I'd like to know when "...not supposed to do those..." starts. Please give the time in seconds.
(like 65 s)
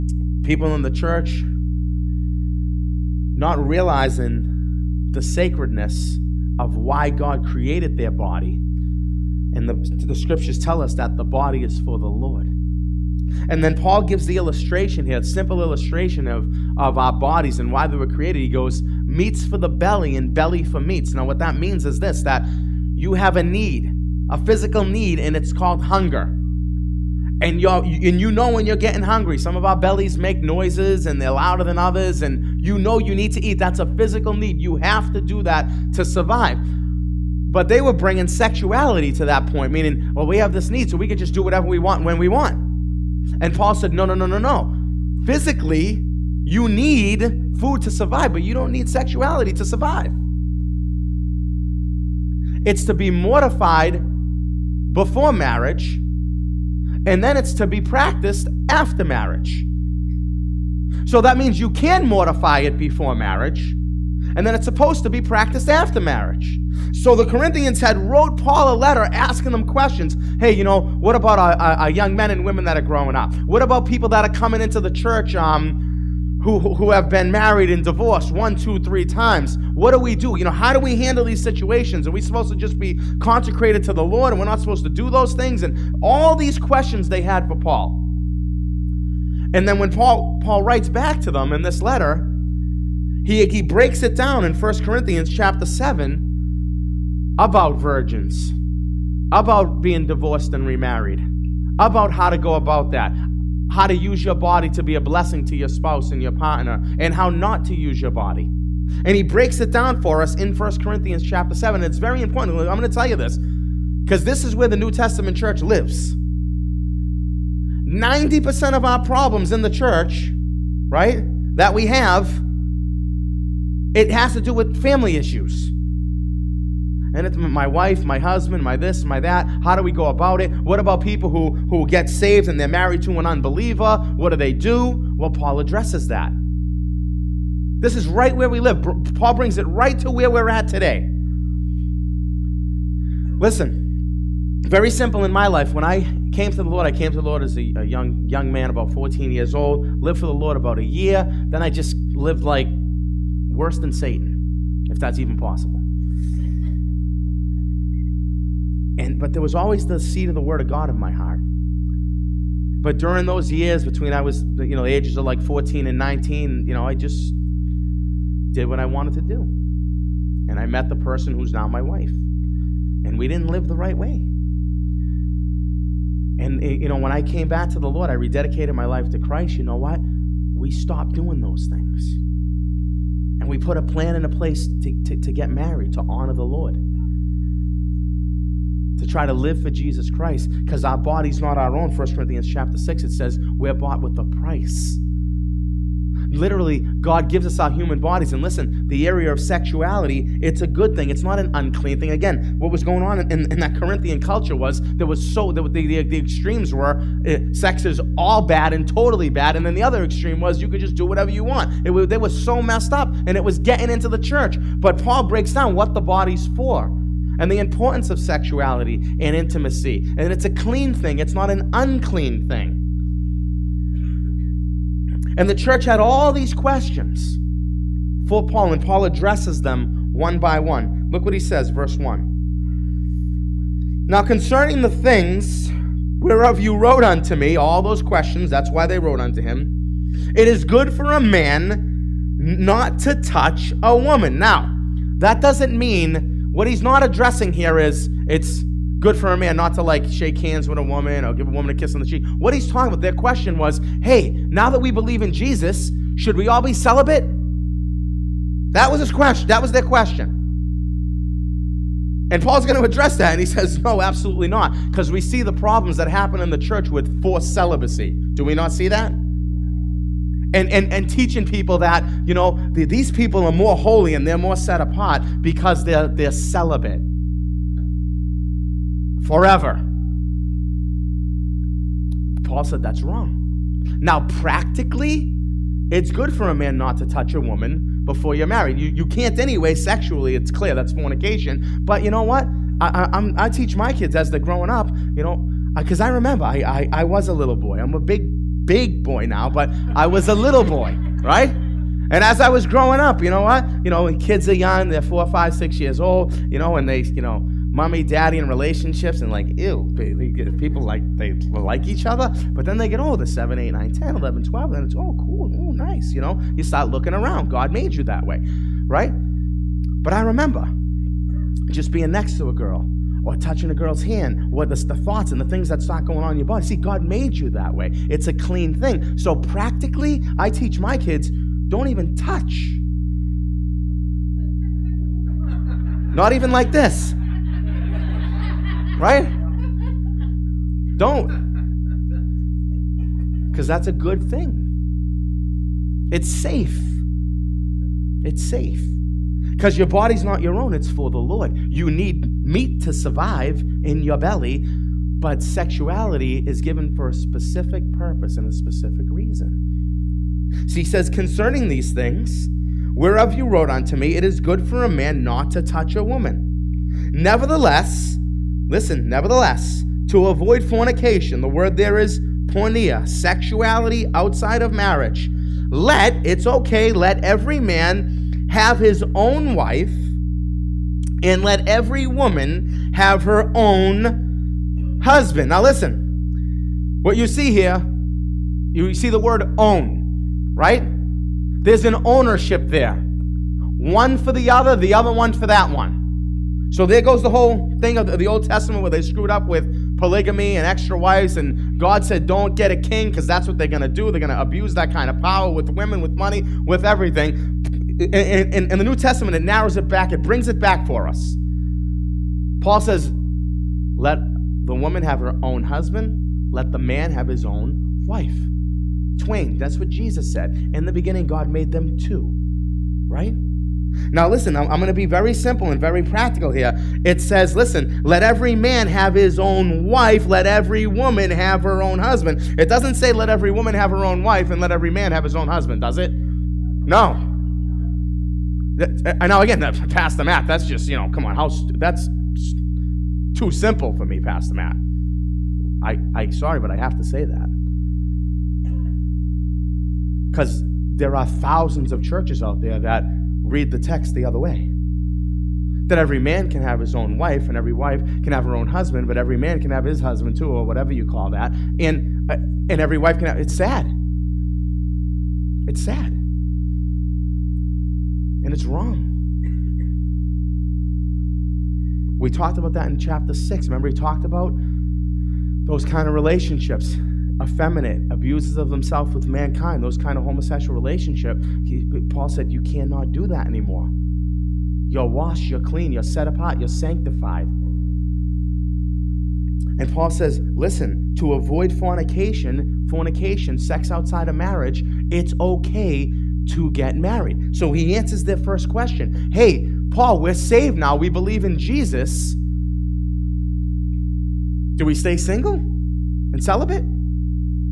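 84 s.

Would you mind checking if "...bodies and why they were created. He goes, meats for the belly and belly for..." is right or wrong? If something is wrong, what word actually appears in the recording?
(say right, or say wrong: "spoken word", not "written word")
right.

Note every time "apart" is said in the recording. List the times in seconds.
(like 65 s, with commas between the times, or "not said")
274 s, 486 s.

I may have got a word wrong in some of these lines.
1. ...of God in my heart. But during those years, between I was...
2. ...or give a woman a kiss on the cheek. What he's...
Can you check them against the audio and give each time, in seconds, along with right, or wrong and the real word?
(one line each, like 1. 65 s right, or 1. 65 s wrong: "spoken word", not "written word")
1. 160 s right
2. 251 s right.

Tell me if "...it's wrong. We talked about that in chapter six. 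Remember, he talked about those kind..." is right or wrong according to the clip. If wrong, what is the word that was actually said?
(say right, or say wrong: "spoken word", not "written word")
right.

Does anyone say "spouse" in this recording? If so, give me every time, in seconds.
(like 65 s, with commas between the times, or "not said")
105 s.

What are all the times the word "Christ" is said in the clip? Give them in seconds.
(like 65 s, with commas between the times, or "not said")
179 s, 190 s.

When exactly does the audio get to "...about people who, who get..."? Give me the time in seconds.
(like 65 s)
130 s.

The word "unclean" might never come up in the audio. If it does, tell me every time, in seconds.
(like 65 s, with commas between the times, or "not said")
201 s, 221 s.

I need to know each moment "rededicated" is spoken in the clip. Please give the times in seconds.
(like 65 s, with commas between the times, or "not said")
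178 s.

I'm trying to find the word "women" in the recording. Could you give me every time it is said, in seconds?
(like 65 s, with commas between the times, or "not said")
72 s, 405 s.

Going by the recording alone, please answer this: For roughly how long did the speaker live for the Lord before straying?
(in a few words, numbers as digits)
about a year.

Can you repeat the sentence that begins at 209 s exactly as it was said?
And then the other extreme was you could just do whatever you want.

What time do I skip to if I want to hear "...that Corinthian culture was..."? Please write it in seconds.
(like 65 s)
203 s.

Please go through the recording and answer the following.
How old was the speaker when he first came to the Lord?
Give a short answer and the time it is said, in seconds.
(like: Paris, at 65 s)
14, at 148 s.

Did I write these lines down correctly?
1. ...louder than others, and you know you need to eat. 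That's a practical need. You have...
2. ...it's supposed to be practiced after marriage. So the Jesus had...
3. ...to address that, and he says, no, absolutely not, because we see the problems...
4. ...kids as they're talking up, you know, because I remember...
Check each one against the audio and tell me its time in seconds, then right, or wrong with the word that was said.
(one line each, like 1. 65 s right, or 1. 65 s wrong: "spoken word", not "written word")
1. 31 s wrong: "physical", not "practical"
2. 64 s wrong: "Corinthians", not "Jesus"
3. 262 s right
4. 293 s wrong: "growing", not "talking".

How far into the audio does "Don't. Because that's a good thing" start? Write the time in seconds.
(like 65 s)
340 s.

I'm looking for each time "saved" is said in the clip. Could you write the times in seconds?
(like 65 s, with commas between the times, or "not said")
132 s, 500 s.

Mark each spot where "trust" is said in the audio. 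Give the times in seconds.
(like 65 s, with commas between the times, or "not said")
not said.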